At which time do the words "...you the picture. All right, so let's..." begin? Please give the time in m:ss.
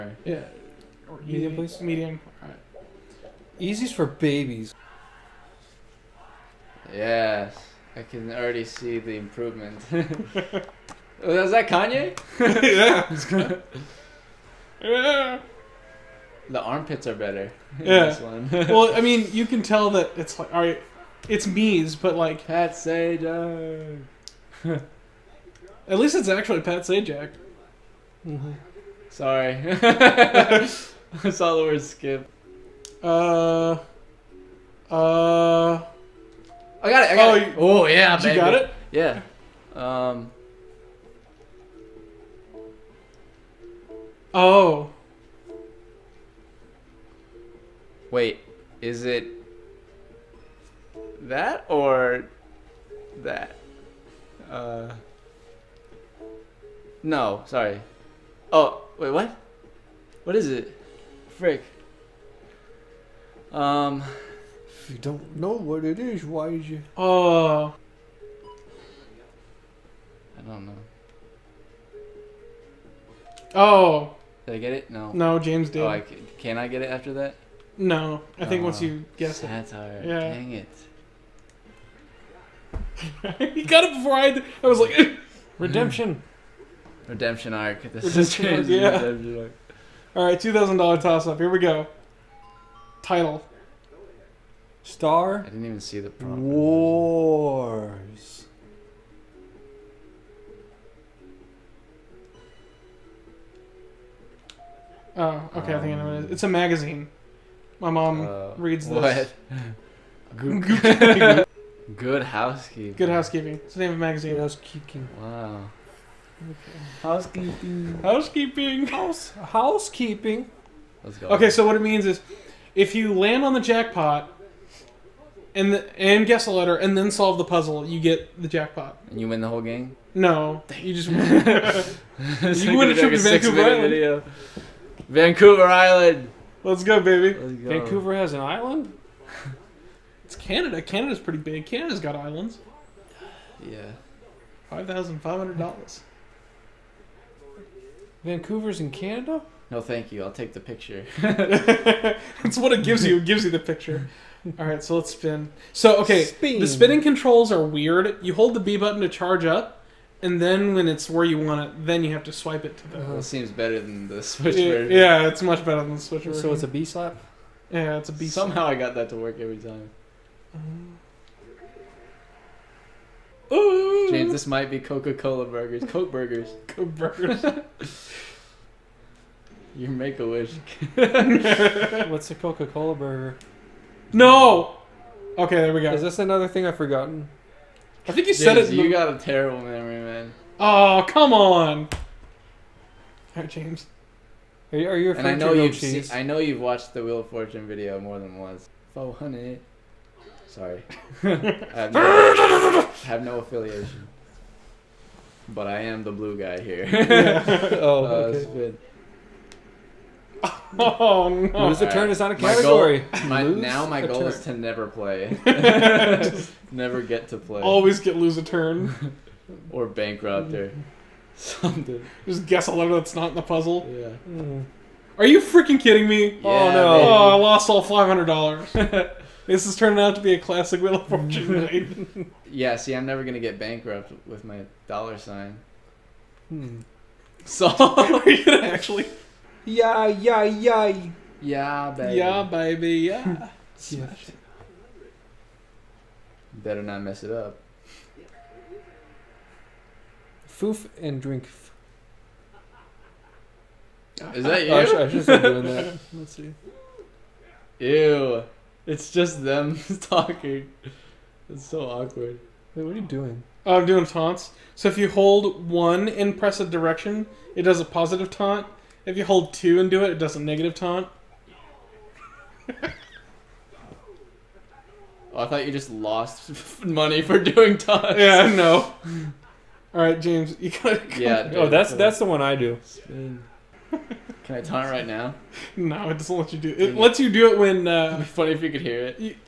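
2:33.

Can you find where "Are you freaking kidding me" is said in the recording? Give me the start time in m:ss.
3:45.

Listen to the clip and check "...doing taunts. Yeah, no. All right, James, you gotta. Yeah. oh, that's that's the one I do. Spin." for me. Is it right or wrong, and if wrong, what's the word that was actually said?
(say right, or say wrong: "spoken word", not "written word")
right.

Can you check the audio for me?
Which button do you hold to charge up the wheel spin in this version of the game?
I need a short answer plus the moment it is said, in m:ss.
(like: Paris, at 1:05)
B button, at 2:38.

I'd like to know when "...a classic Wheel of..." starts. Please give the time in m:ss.
3:50.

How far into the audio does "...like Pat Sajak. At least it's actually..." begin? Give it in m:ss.
0:22.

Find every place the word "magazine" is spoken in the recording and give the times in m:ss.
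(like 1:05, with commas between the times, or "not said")
1:46, 1:53.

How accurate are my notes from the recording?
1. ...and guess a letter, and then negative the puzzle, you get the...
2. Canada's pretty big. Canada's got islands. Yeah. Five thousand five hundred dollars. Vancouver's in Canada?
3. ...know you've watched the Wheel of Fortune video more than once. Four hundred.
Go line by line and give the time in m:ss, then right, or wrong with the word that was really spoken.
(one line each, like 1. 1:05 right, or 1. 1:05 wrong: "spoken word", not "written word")
1. 2:05 wrong: "solve", not "negative"
2. 2:20 right
3. 3:16 right.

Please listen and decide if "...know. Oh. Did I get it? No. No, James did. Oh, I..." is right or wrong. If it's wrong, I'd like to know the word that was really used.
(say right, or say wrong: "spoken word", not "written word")
right.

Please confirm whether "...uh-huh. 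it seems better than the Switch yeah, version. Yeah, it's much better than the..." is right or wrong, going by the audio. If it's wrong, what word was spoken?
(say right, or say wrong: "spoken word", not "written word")
right.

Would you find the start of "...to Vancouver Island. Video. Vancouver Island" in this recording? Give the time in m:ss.
2:13.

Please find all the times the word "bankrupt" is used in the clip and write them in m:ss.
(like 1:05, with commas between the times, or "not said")
3:39, 3:53.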